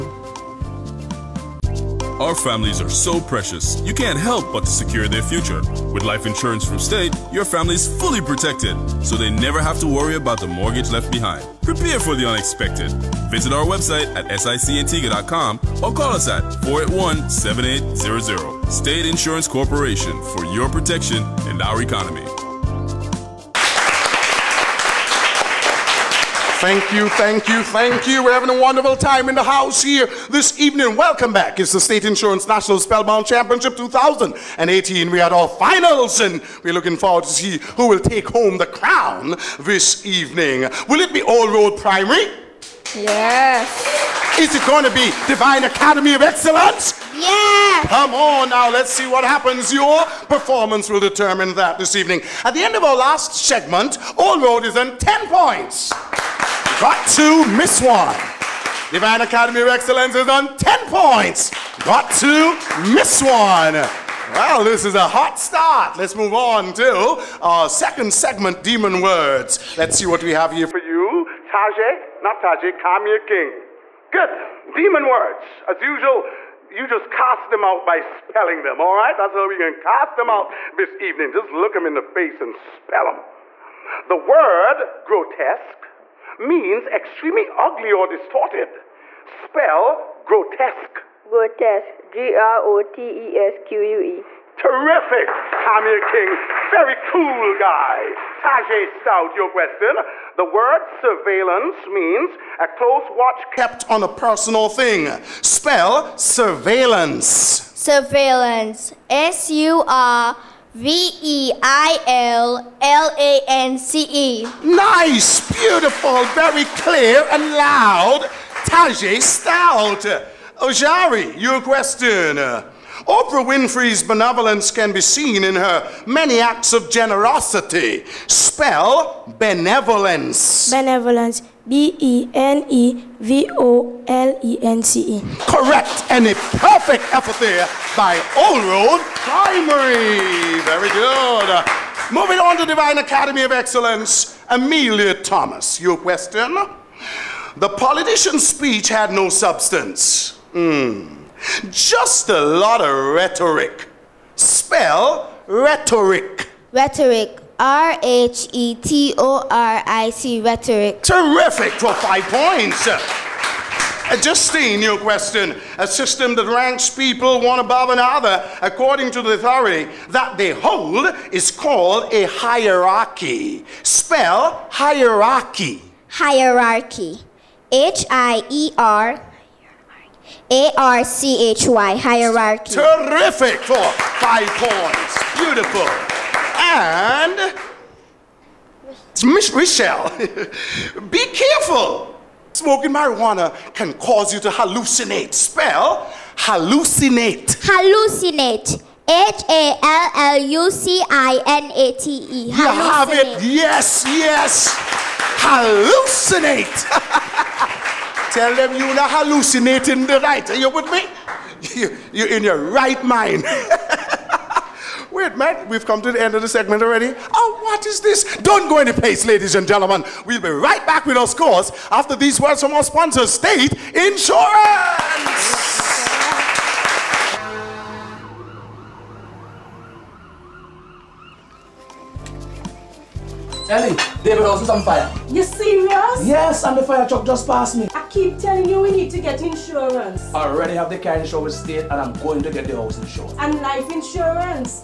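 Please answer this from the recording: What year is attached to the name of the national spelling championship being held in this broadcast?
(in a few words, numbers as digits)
2018.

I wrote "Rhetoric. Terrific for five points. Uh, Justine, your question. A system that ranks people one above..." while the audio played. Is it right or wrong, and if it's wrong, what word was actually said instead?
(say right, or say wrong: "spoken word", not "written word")
right.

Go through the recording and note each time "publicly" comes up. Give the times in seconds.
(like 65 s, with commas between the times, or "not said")
not said.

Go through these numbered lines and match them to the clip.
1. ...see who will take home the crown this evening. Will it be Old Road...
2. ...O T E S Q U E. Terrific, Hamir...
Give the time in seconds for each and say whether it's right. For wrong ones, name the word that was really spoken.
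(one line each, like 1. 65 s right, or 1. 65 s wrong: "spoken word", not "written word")
1. 37 s right
2. 92 s right.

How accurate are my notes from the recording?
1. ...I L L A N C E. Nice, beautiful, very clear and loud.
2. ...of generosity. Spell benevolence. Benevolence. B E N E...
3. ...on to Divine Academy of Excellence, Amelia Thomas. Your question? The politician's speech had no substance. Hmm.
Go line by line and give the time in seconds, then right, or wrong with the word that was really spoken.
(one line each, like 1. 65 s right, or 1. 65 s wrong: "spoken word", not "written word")
1. 111 s right
2. 126 s right
3. 142 s right.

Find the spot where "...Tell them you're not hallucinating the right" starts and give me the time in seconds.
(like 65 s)
208 s.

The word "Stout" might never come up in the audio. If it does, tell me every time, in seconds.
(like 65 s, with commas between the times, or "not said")
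98 s, 119 s.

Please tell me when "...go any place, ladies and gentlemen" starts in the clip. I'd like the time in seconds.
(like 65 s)
218 s.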